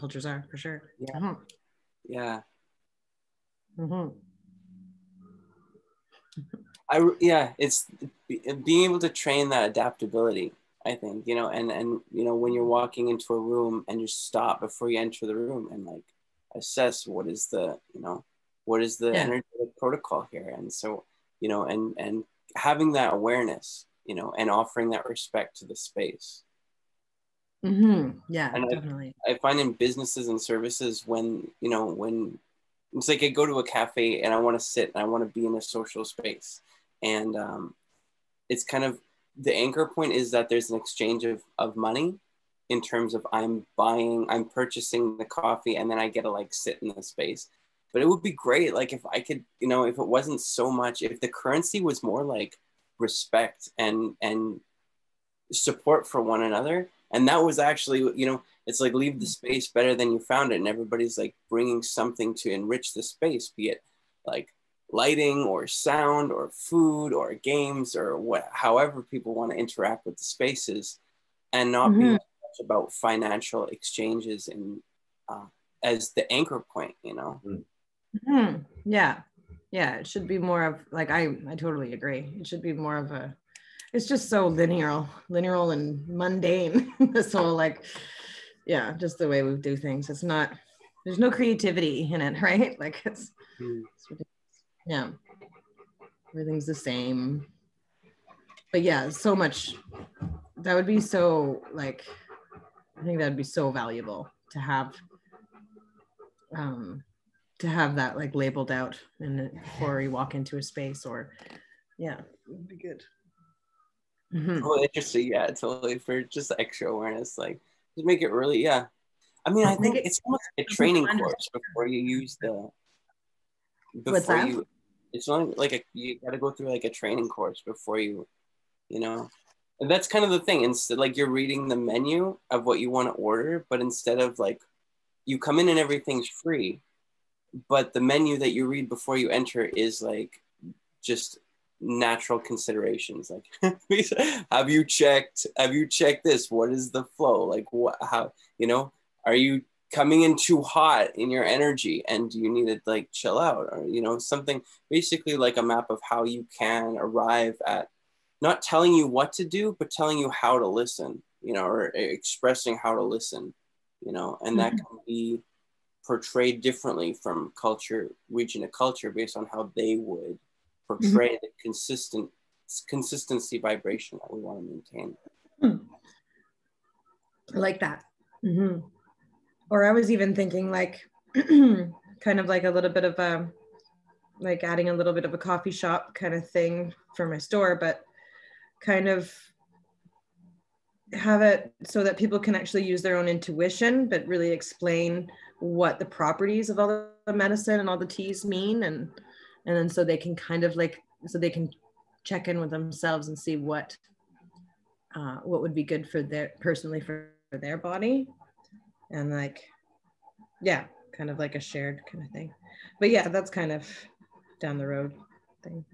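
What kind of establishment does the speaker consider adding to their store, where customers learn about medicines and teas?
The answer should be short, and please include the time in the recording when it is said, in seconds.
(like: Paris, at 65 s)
coffee shop, at 185 s.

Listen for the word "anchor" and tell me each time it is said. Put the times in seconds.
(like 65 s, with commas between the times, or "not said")
39 s, 76 s.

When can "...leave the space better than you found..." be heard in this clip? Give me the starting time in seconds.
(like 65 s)
58 s.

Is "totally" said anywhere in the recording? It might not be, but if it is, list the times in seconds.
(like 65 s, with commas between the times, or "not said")
81 s, 115 s.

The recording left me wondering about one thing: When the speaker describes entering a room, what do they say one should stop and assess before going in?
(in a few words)
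protocol.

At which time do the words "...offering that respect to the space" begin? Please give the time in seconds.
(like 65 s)
24 s.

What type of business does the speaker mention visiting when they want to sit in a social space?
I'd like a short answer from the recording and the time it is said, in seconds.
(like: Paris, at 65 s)
cafe, at 33 s.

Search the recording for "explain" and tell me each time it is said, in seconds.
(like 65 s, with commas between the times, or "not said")
194 s.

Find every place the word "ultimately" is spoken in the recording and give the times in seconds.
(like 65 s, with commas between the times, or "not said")
not said.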